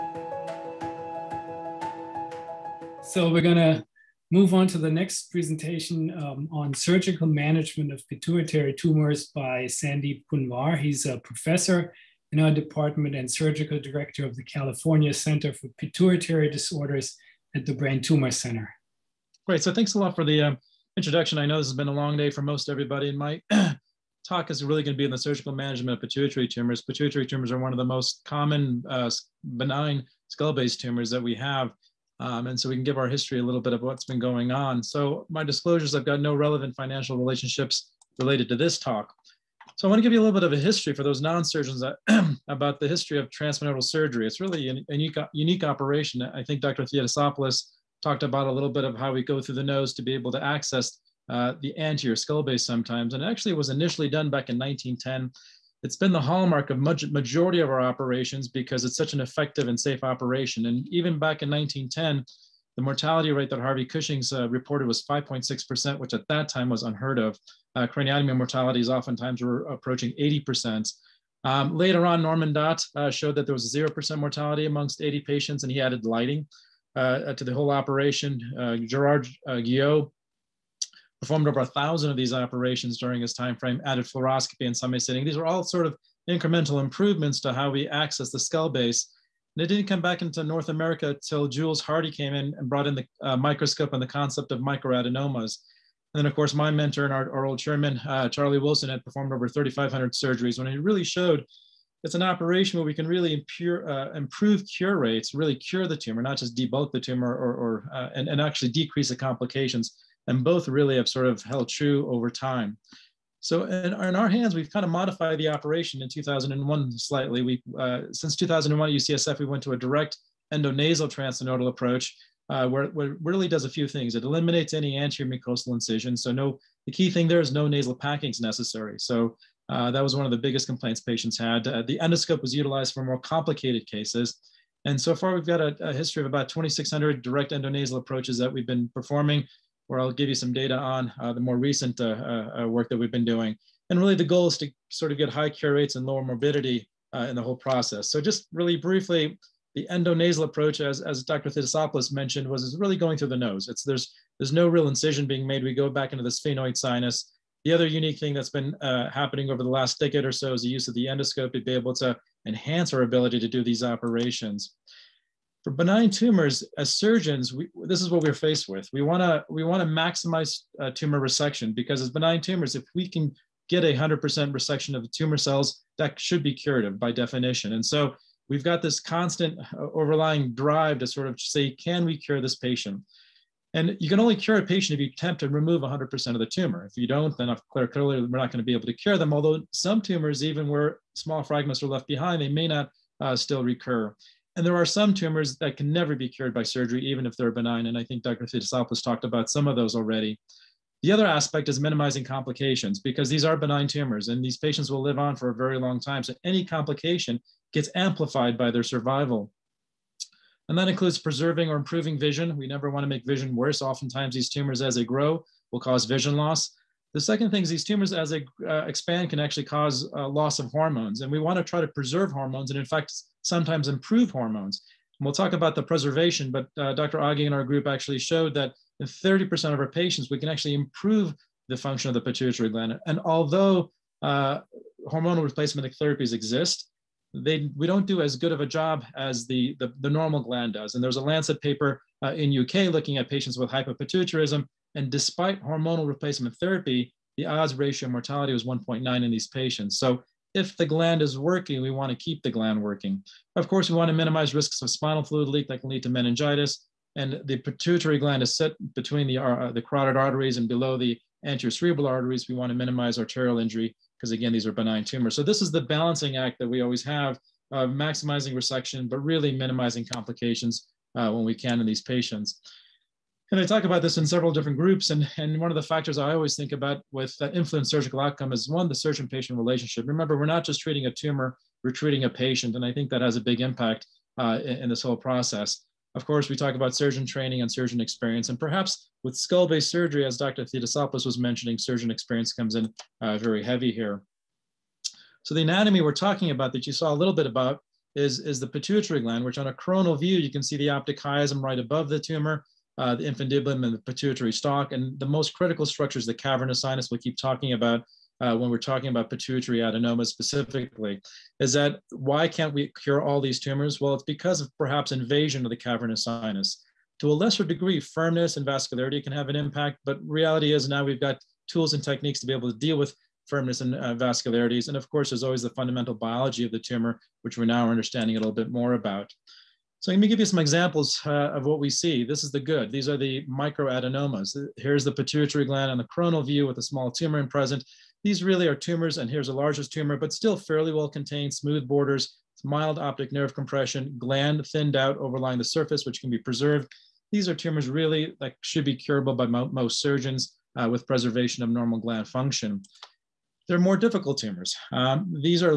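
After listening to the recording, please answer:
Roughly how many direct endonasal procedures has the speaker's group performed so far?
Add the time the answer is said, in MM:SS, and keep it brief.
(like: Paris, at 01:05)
2,600, at 02:16.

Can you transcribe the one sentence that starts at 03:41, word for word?
And we want to try to preserve hormones and, in fact, sometimes improve hormones.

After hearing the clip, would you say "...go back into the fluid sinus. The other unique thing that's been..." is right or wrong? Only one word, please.
wrong.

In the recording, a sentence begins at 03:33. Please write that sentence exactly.
Oftentimes, these tumors, as they grow, will cause vision loss.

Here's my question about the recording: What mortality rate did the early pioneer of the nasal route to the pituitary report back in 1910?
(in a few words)
5.6%.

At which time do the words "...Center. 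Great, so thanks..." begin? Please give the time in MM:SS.
00:18.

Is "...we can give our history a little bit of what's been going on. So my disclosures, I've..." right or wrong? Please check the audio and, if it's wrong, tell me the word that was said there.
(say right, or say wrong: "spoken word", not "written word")
right.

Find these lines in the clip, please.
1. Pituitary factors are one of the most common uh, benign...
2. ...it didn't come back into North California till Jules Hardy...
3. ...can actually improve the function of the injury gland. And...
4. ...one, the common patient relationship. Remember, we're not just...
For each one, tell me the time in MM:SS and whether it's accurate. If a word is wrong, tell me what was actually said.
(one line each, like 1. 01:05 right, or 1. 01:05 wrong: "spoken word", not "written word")
1. 00:26 wrong: "tumors", not "factors"
2. 01:29 wrong: "America", not "California"
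3. 03:50 wrong: "pituitary", not "injury"
4. 04:38 wrong: "surgeon", not "common".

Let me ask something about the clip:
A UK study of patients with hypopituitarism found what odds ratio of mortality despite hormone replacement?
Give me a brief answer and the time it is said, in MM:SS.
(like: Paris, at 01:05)
1.9, at 04:08.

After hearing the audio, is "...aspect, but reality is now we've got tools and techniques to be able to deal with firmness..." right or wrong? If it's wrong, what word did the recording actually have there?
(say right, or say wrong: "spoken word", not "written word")
wrong: "impact", not "aspect".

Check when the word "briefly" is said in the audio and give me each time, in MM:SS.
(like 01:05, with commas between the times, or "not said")
02:28.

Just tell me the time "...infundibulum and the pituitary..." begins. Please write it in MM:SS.
05:03.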